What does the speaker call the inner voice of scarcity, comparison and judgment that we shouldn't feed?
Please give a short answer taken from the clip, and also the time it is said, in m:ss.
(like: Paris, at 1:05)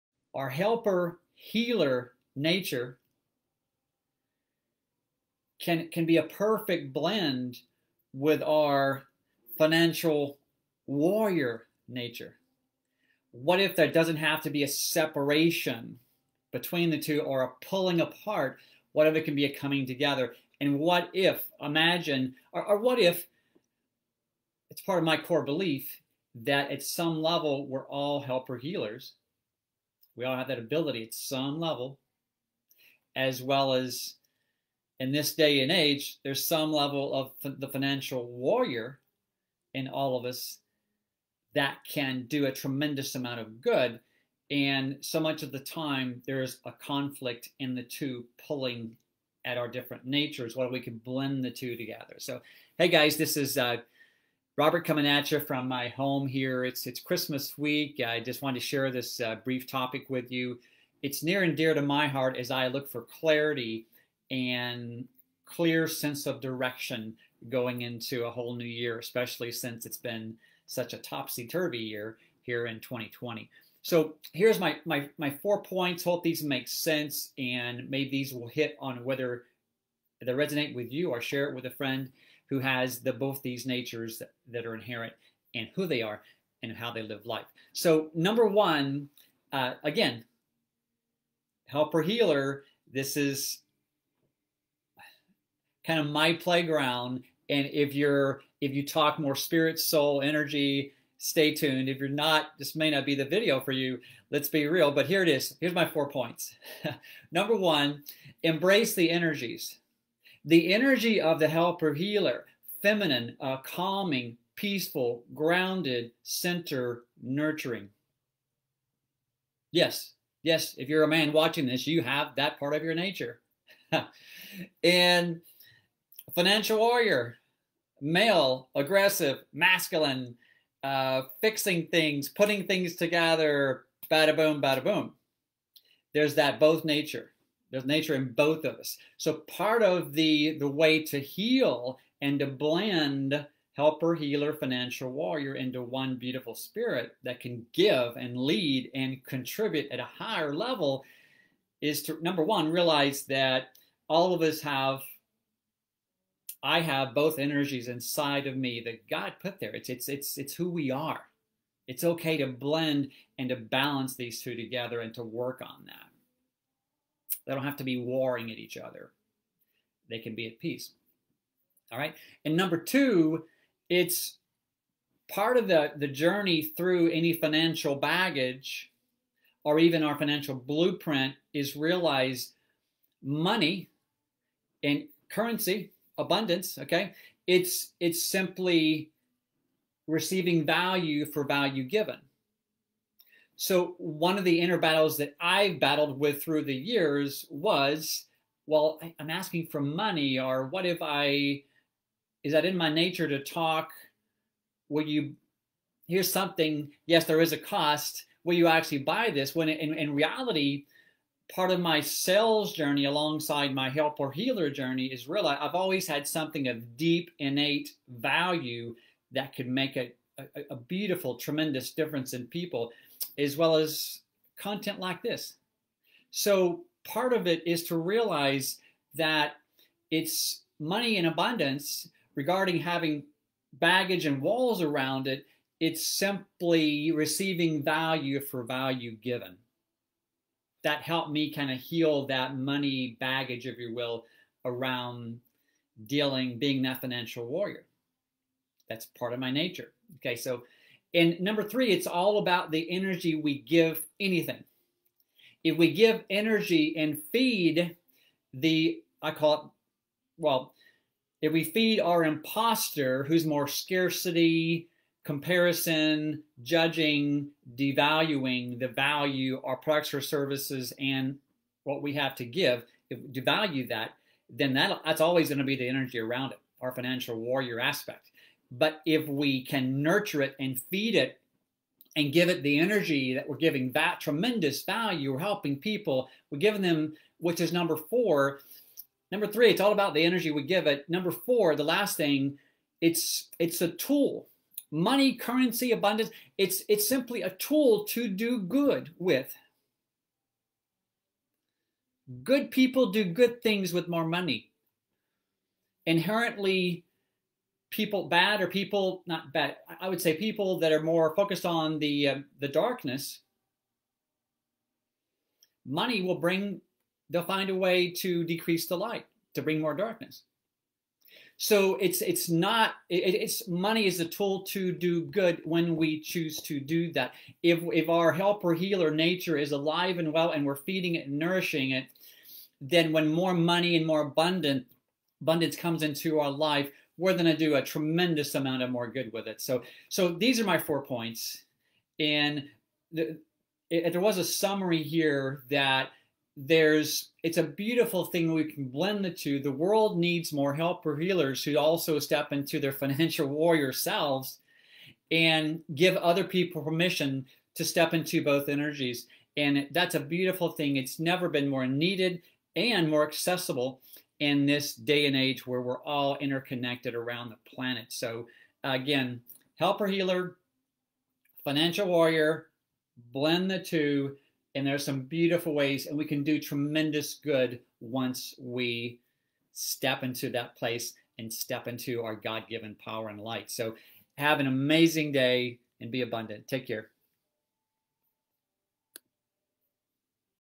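Imposter, at 4:22.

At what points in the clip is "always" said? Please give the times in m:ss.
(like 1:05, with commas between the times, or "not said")
3:35, 4:35.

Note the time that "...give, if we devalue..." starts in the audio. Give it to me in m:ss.
4:32.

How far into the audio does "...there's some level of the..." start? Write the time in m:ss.
0:36.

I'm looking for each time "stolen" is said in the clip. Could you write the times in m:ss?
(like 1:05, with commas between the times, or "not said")
not said.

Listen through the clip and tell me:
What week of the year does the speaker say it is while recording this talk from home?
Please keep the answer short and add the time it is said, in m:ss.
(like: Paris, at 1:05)
Christmas week, at 0:56.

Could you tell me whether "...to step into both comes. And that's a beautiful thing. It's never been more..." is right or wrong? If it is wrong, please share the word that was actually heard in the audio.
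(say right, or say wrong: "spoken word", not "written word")
wrong: "energies", not "comes".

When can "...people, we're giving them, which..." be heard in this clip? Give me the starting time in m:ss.
4:45.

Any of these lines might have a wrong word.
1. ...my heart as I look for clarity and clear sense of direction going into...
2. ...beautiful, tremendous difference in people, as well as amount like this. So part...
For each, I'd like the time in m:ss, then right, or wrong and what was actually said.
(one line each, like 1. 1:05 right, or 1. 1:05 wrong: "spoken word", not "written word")
1. 1:01 right
2. 3:40 wrong: "content", not "amount".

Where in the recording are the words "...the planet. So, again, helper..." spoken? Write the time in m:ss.
6:07.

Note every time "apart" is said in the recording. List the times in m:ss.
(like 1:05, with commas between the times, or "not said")
0:18.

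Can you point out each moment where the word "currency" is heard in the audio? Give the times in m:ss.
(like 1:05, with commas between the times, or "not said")
3:05, 4:55.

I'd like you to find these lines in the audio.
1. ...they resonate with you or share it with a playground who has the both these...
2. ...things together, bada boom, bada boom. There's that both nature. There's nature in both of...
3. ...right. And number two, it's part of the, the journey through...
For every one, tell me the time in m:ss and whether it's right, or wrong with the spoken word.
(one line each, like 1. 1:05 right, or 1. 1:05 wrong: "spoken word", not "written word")
1. 1:20 wrong: "friend", not "playground"
2. 2:12 right
3. 2:51 right.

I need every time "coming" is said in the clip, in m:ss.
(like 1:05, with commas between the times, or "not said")
0:19, 0:54.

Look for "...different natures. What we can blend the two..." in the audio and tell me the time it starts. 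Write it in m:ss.
0:49.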